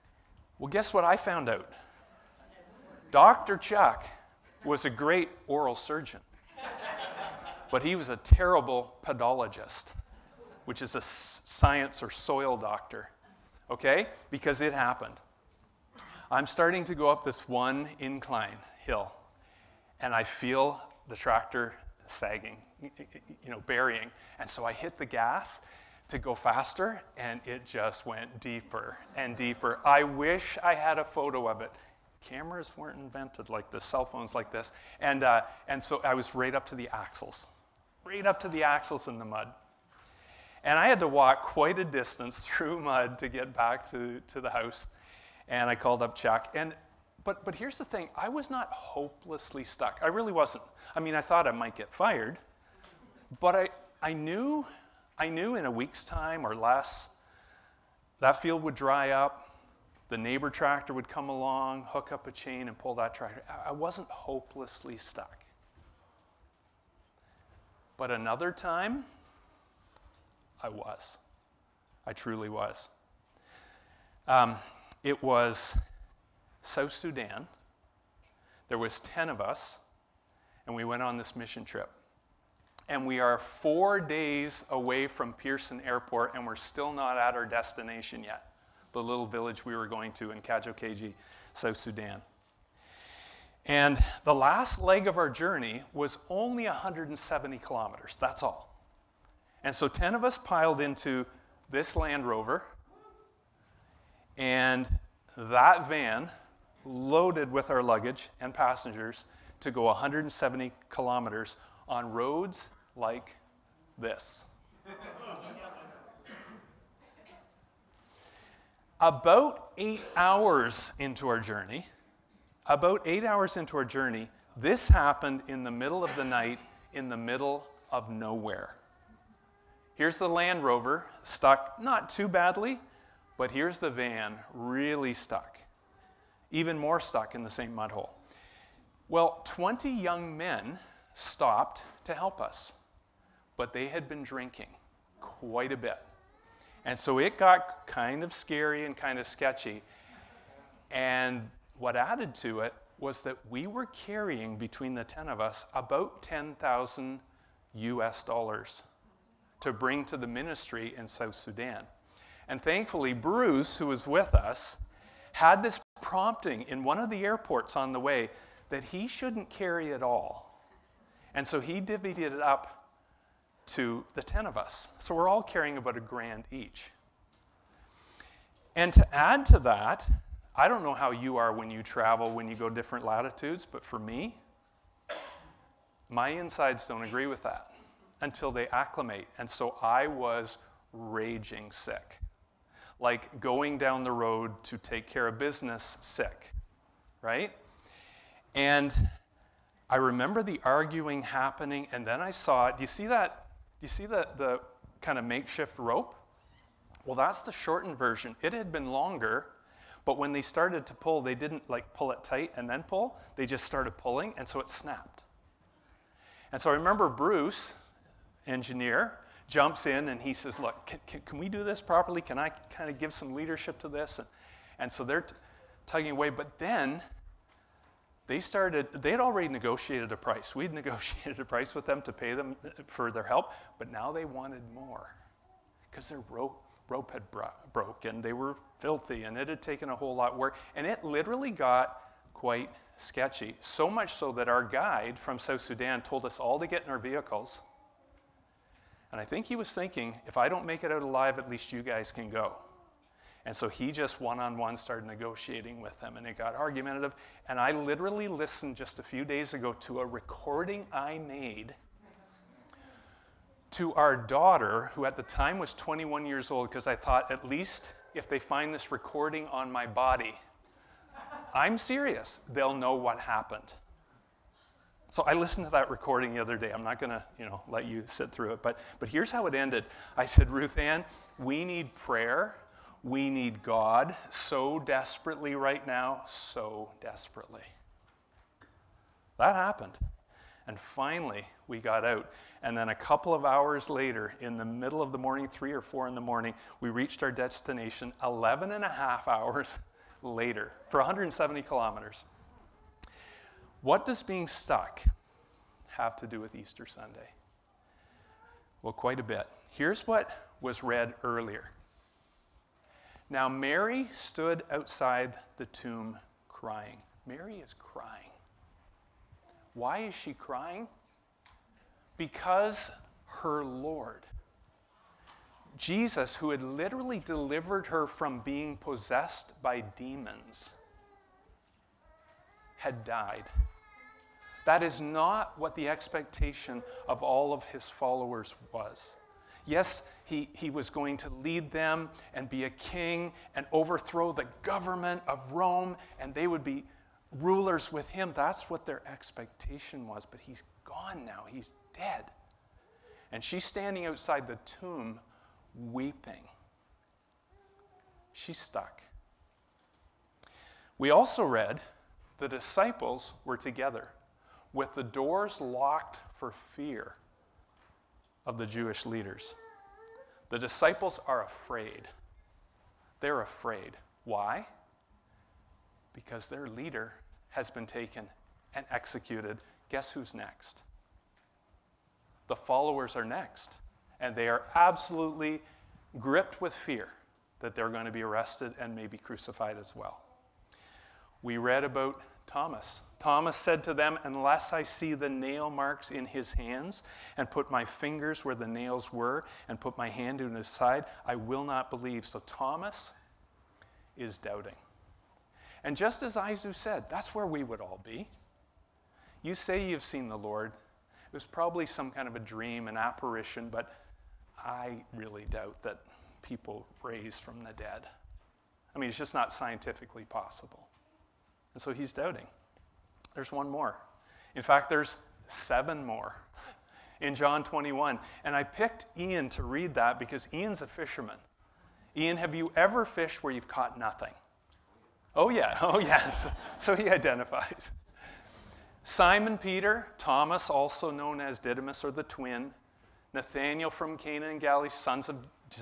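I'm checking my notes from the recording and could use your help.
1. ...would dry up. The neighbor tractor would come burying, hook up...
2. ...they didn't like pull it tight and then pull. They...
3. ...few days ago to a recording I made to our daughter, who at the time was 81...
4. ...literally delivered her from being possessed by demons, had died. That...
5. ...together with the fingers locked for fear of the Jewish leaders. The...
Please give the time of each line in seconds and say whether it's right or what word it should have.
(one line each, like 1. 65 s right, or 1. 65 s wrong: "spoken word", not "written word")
1. 58 s wrong: "along", not "burying"
2. 211 s right
3. 259 s wrong: "21", not "81"
4. 326 s right
5. 363 s wrong: "doors", not "fingers".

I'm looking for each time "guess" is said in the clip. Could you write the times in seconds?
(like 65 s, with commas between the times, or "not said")
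0 s, 379 s.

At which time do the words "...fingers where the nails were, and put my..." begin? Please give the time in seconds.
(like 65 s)
397 s.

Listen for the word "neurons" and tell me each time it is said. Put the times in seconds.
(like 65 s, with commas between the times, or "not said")
not said.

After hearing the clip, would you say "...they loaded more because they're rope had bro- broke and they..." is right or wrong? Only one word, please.
wrong.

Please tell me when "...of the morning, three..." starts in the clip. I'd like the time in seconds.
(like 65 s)
295 s.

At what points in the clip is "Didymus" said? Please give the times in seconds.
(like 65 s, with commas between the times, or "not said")
441 s.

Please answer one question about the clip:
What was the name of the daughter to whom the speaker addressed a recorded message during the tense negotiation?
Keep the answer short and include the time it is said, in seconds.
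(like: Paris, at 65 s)
Ruth Ann, at 280 s.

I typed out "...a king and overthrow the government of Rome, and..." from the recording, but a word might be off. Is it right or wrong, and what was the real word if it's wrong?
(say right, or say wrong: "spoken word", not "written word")
right.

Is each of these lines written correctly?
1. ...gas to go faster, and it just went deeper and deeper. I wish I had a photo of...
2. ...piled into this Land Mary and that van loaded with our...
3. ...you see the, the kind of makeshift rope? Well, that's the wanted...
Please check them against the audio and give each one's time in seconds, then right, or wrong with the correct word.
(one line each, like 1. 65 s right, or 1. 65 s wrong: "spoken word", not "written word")
1. 25 s right
2. 100 s wrong: "Rover", not "Mary"
3. 203 s wrong: "shortened", not "wanted".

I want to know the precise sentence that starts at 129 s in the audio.
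Here's the Land Rover, stuck not too badly, but here's the van, really stuck.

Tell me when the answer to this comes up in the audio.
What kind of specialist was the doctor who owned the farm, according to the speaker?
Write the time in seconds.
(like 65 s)
5 s.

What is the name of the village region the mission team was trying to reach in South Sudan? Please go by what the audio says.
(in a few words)
Kajokeji.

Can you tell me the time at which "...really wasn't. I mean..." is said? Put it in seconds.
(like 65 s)
50 s.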